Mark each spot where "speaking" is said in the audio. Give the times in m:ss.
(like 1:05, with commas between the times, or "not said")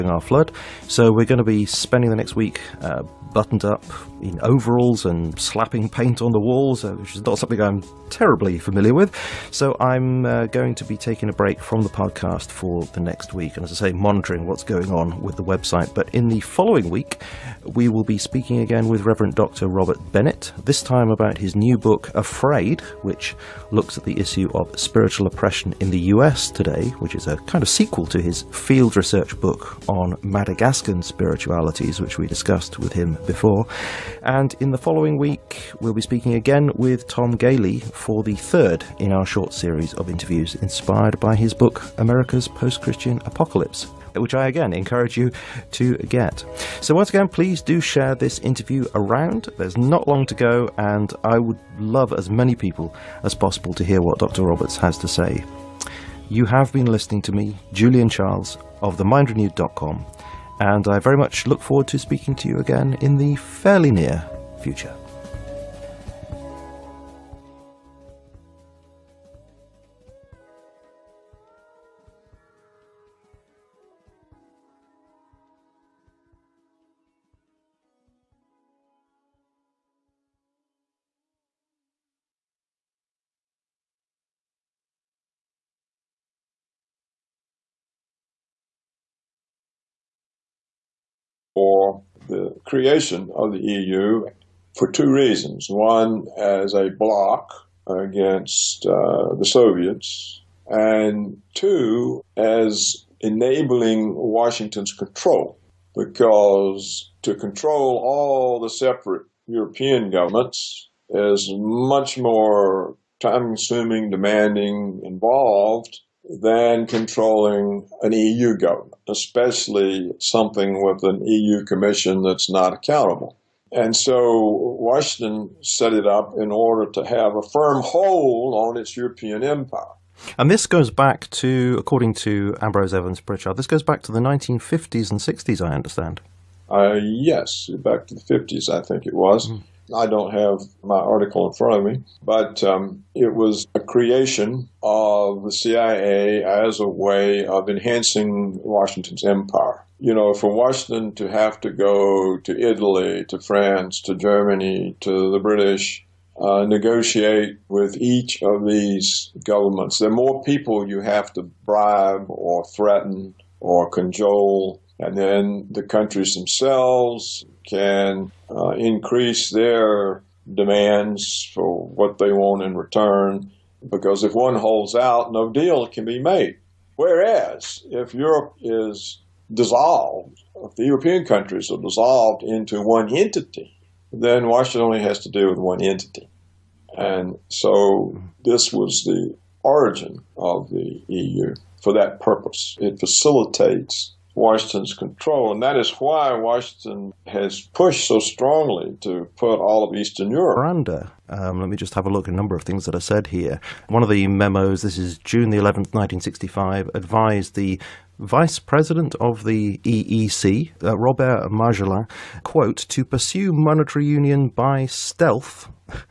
0:18, 0:36, 1:01.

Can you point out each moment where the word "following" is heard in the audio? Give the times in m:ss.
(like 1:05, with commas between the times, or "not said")
0:16, 0:34.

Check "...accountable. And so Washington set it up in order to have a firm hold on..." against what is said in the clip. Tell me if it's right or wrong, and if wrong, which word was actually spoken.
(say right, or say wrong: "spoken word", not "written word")
right.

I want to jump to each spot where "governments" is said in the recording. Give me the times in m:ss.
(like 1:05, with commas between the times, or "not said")
1:50, 1:58, 2:39.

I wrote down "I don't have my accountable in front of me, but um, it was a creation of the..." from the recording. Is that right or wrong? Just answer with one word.
wrong.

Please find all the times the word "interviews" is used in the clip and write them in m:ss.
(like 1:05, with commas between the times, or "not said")
0:40, 0:48.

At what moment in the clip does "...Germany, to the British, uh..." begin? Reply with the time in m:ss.
2:34.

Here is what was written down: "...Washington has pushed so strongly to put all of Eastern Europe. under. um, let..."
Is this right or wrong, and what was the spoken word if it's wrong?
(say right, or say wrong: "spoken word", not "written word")
right.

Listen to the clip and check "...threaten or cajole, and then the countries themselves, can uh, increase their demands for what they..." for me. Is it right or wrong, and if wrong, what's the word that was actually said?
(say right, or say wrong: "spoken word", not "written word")
right.